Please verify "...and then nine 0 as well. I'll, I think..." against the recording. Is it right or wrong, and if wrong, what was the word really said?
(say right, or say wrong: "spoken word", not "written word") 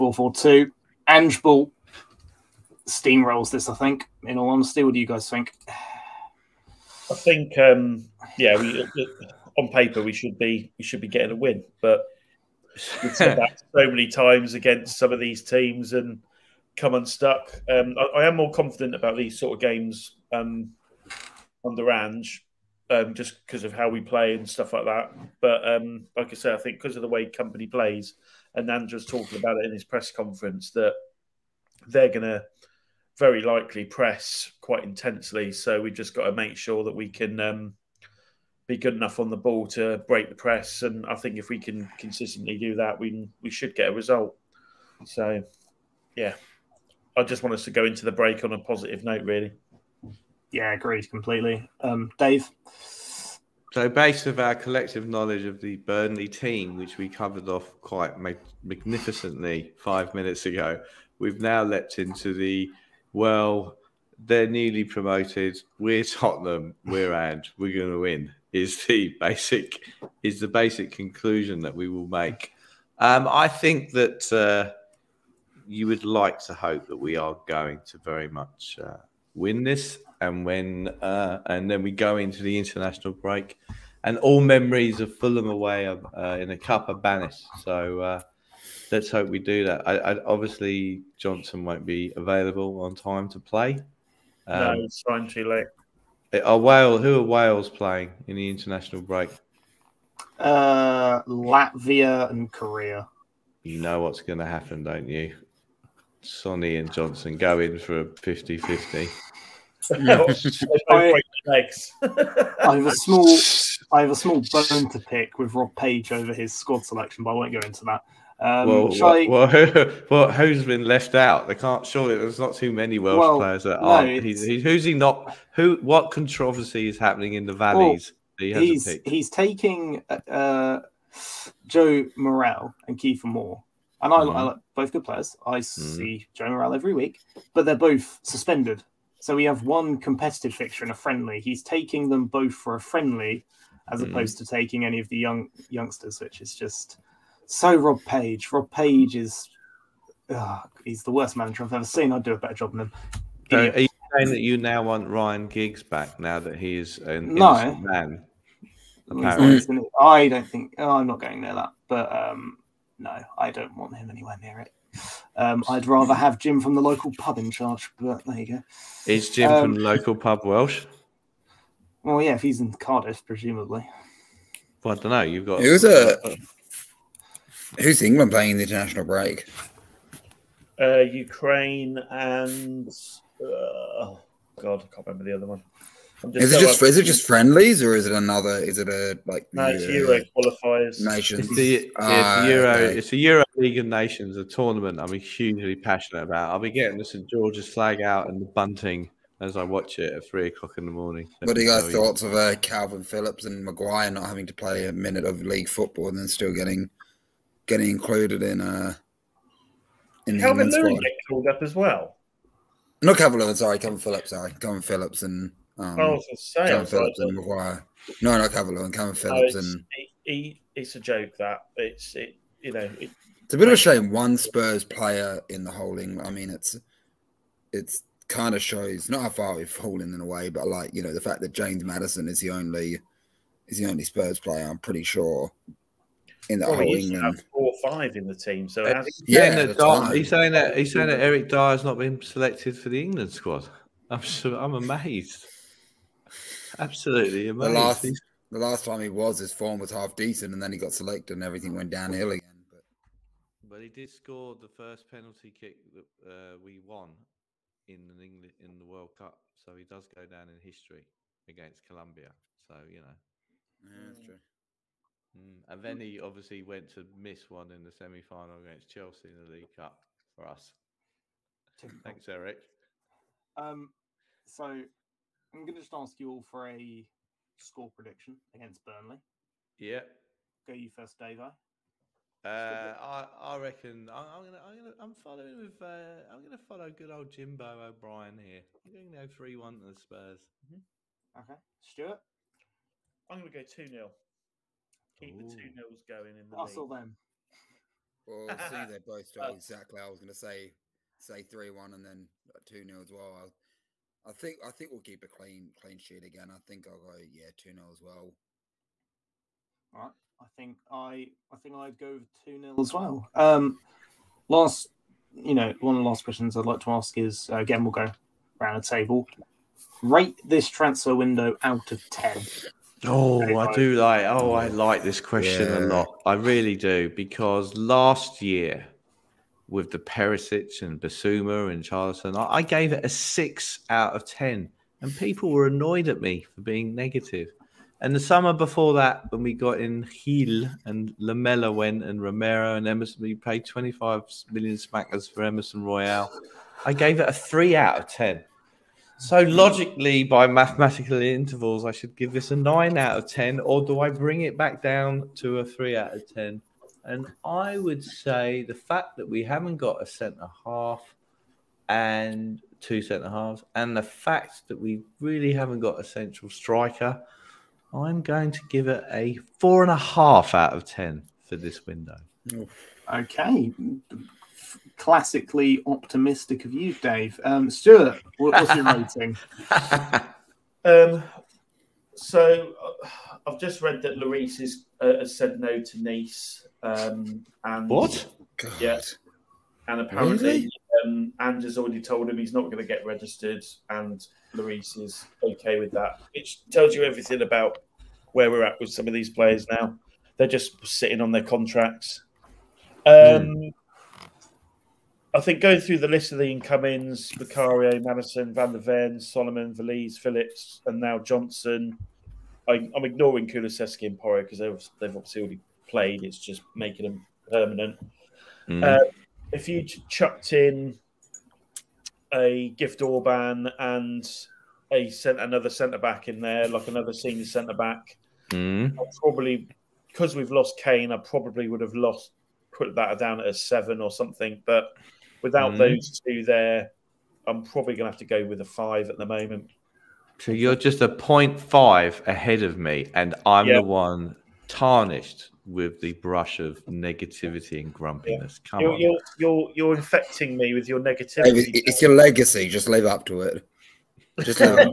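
wrong: "two", not "nine".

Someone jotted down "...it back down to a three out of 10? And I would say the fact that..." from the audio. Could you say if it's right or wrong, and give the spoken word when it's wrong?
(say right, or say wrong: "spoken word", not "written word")
right.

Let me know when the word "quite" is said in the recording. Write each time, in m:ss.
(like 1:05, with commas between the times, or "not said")
0:34, 0:57.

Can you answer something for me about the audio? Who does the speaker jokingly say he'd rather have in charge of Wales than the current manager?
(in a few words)
Jim from the local pub.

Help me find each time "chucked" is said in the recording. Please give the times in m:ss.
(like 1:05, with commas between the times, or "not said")
7:00.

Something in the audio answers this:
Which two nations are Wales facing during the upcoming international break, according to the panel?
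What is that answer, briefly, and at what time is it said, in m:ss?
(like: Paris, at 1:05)
Latvia and Korea, at 1:41.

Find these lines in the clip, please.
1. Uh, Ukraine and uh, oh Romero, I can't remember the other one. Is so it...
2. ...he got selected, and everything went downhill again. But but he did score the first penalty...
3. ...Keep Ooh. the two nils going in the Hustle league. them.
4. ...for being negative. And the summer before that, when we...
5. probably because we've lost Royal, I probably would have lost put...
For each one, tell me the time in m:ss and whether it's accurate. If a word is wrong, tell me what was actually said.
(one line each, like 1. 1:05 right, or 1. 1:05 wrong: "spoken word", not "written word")
1. 3:00 wrong: "God", not "Romero"
2. 4:10 right
3. 4:55 right
4. 5:36 right
5. 7:09 wrong: "Kane", not "Royal".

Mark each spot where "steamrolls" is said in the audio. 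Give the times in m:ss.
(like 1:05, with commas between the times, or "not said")
0:02.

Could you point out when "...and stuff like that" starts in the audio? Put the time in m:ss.
0:24.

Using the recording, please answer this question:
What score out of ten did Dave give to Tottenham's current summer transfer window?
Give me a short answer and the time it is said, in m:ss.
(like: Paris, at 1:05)
4.5, at 6:09.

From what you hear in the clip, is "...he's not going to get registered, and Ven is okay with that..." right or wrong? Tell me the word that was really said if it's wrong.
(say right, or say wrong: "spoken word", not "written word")
wrong: "Luis", not "Ven".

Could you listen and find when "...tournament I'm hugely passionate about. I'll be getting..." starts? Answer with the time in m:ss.
3:14.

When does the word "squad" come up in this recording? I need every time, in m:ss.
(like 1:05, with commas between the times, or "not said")
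1:56, 4:03.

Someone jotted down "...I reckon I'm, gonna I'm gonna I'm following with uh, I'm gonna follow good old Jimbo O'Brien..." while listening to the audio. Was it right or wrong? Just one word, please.
right.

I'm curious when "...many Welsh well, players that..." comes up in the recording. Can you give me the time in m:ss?
2:02.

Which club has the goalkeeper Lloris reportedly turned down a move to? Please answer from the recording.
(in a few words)
Nice.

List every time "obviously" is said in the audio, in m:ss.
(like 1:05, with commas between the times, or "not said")
1:30, 4:26, 6:55.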